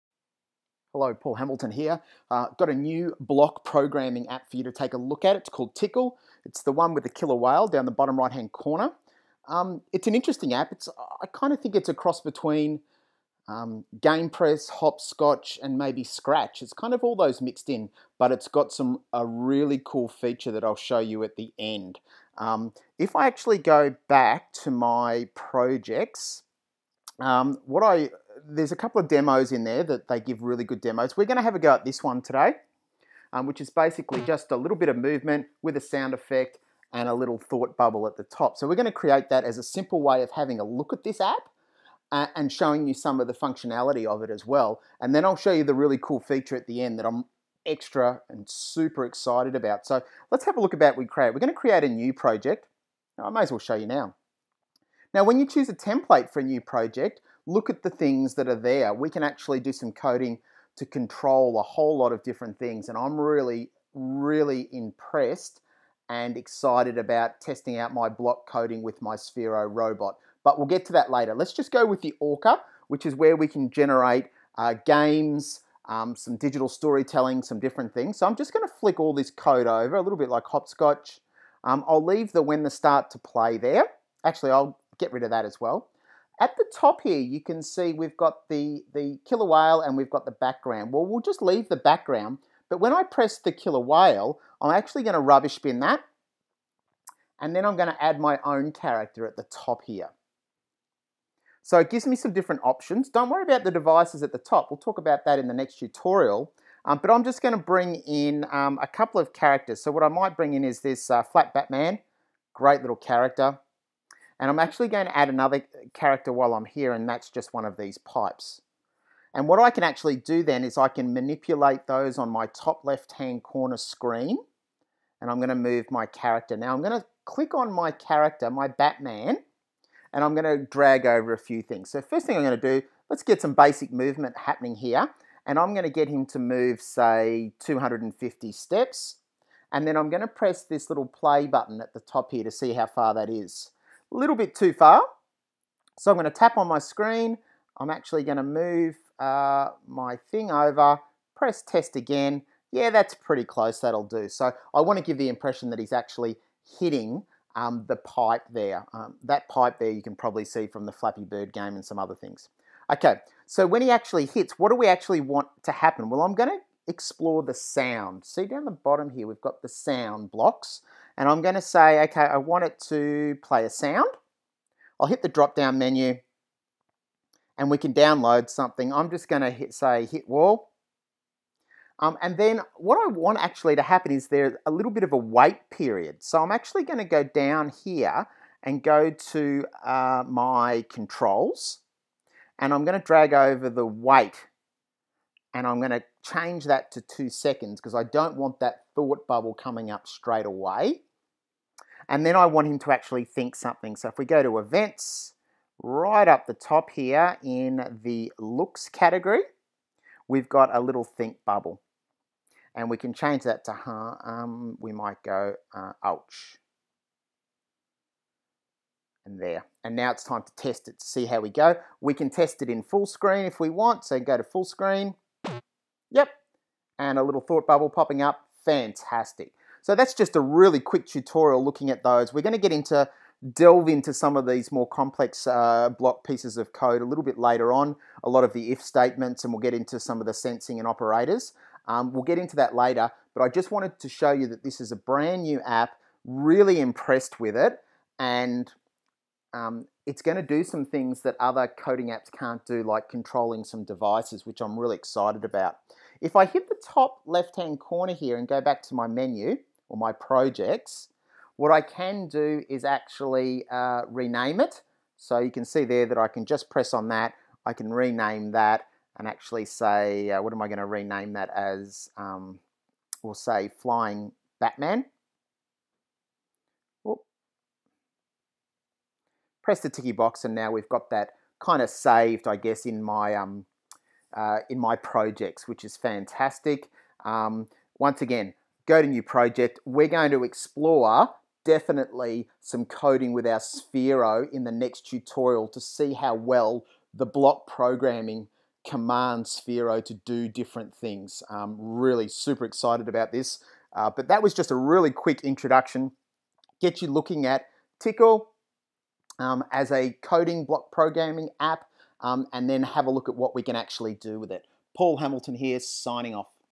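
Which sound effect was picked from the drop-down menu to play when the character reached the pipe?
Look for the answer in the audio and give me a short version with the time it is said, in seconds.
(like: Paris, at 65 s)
Hit wall, at 180 s.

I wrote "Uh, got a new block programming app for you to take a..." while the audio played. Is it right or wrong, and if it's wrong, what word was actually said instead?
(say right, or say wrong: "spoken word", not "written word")
right.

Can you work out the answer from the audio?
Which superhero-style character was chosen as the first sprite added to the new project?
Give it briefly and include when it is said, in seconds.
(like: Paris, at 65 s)
Flat Batman, at 111 s.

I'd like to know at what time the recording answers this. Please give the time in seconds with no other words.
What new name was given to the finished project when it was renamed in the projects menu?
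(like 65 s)
273 s.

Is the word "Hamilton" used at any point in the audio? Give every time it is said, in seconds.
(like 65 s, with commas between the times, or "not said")
1 s, 315 s.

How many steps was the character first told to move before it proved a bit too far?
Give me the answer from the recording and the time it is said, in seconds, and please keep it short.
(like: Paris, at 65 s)
250, at 137 s.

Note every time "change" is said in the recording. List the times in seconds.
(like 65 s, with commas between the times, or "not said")
196 s, 213 s.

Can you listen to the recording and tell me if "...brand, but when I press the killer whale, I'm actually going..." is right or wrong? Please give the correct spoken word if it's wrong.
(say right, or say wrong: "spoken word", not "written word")
wrong: "background", not "brand".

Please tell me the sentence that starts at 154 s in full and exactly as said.
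So I want to give the impression that he's actually hitting um, the pipe there.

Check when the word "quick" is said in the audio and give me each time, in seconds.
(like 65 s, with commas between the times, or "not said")
230 s, 305 s.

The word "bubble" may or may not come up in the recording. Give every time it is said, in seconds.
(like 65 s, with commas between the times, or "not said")
37 s, 199 s, 211 s, 227 s.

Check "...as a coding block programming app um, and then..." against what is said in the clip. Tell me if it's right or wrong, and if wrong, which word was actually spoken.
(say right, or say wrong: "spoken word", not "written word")
right.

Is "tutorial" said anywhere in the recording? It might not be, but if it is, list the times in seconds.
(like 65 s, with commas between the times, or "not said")
105 s, 231 s, 295 s.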